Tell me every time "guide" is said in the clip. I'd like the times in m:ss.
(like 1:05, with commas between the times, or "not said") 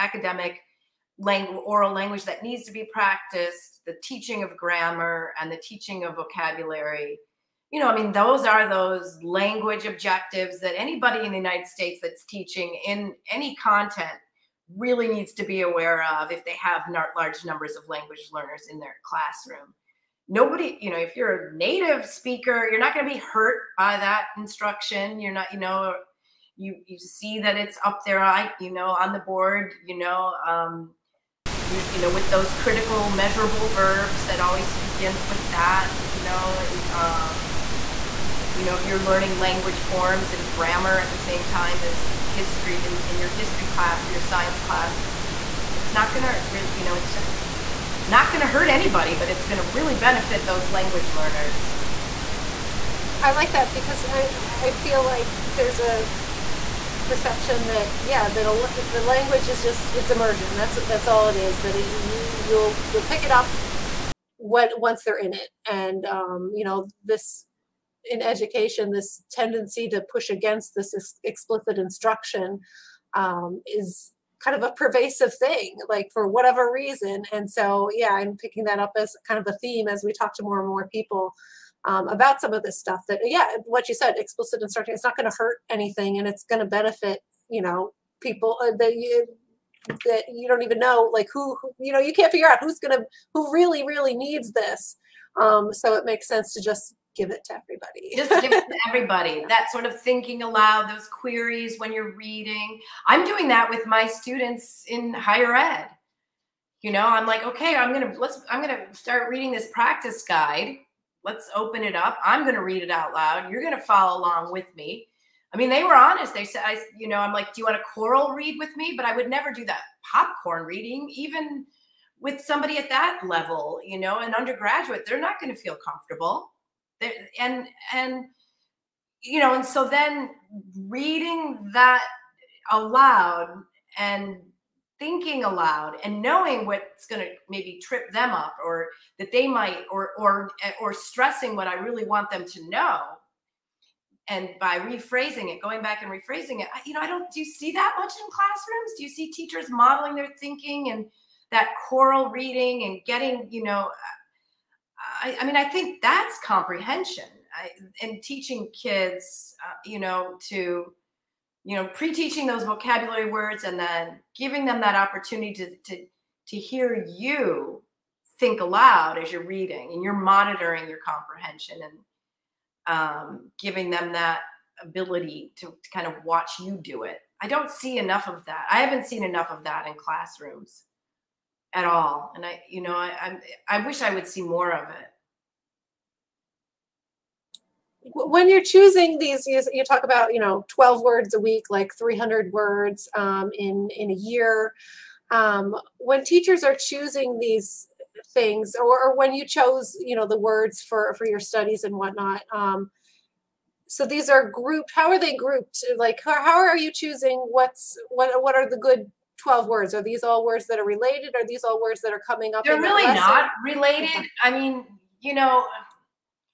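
1:50.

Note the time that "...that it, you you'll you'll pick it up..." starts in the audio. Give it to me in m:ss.
1:01.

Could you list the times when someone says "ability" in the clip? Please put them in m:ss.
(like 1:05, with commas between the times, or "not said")
2:54.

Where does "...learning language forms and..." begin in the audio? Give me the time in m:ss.
0:39.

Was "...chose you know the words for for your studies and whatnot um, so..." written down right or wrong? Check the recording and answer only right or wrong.
right.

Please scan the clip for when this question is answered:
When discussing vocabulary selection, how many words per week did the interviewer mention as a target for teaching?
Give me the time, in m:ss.
3:10.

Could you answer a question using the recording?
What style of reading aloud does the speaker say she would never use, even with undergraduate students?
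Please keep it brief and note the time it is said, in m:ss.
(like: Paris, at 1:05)
popcorn reading, at 2:00.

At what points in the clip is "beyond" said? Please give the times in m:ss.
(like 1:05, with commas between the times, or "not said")
not said.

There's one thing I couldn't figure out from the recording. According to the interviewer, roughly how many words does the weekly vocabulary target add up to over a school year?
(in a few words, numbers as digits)
300.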